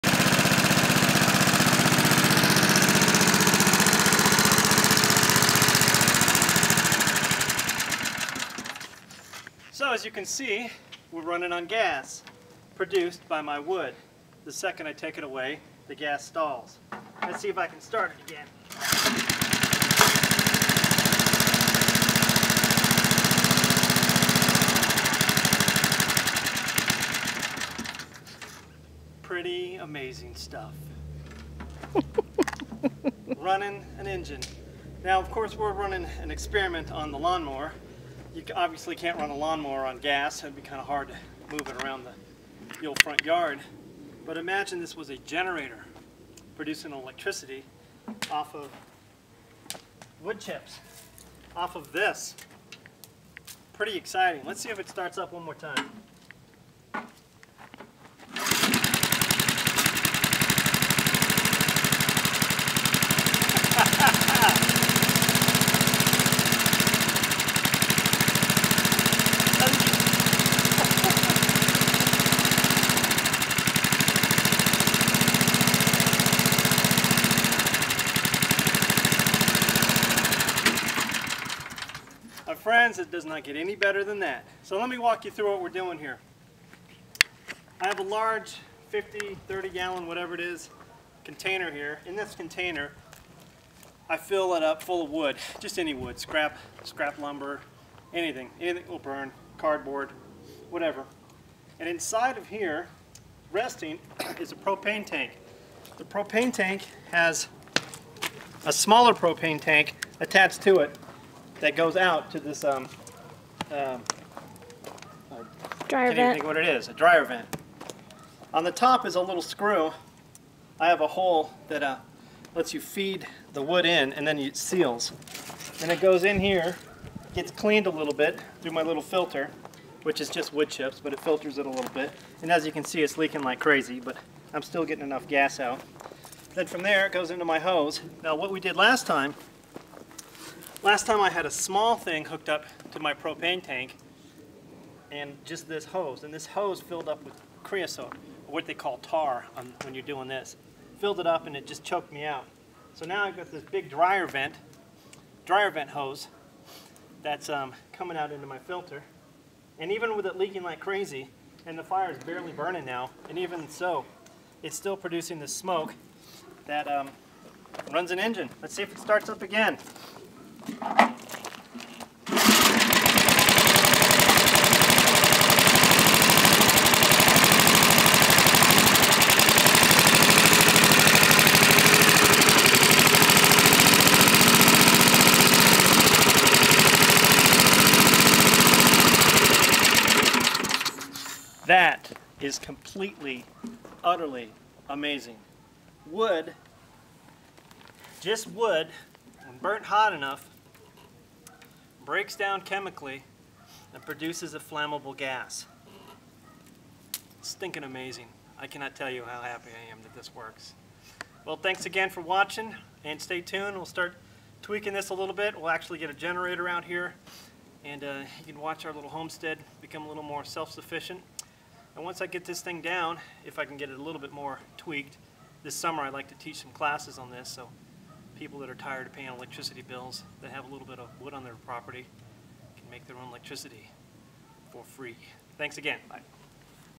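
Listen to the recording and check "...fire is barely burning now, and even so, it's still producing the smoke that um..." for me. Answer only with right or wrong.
right.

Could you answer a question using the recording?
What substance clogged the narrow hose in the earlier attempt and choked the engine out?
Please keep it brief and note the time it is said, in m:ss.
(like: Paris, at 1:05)
Creosote, at 2:27.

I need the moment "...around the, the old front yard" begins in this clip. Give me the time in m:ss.
0:41.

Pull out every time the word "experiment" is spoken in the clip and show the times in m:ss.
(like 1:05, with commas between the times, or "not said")
0:36.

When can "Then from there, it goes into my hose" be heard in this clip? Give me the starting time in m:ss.
2:16.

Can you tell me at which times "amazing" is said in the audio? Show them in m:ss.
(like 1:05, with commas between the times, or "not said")
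0:29, 3:14, 3:27.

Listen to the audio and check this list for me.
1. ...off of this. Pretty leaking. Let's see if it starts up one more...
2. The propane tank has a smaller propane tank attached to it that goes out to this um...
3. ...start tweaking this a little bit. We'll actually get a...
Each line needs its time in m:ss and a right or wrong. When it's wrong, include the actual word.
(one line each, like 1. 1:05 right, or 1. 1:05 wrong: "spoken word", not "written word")
1. 0:51 wrong: "exciting", not "leaking"
2. 1:45 right
3. 3:33 right.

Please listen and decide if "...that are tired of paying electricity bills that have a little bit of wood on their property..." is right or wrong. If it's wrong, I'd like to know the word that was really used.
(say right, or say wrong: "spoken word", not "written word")
right.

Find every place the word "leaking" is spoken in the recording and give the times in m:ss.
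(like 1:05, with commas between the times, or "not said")
2:13, 2:40.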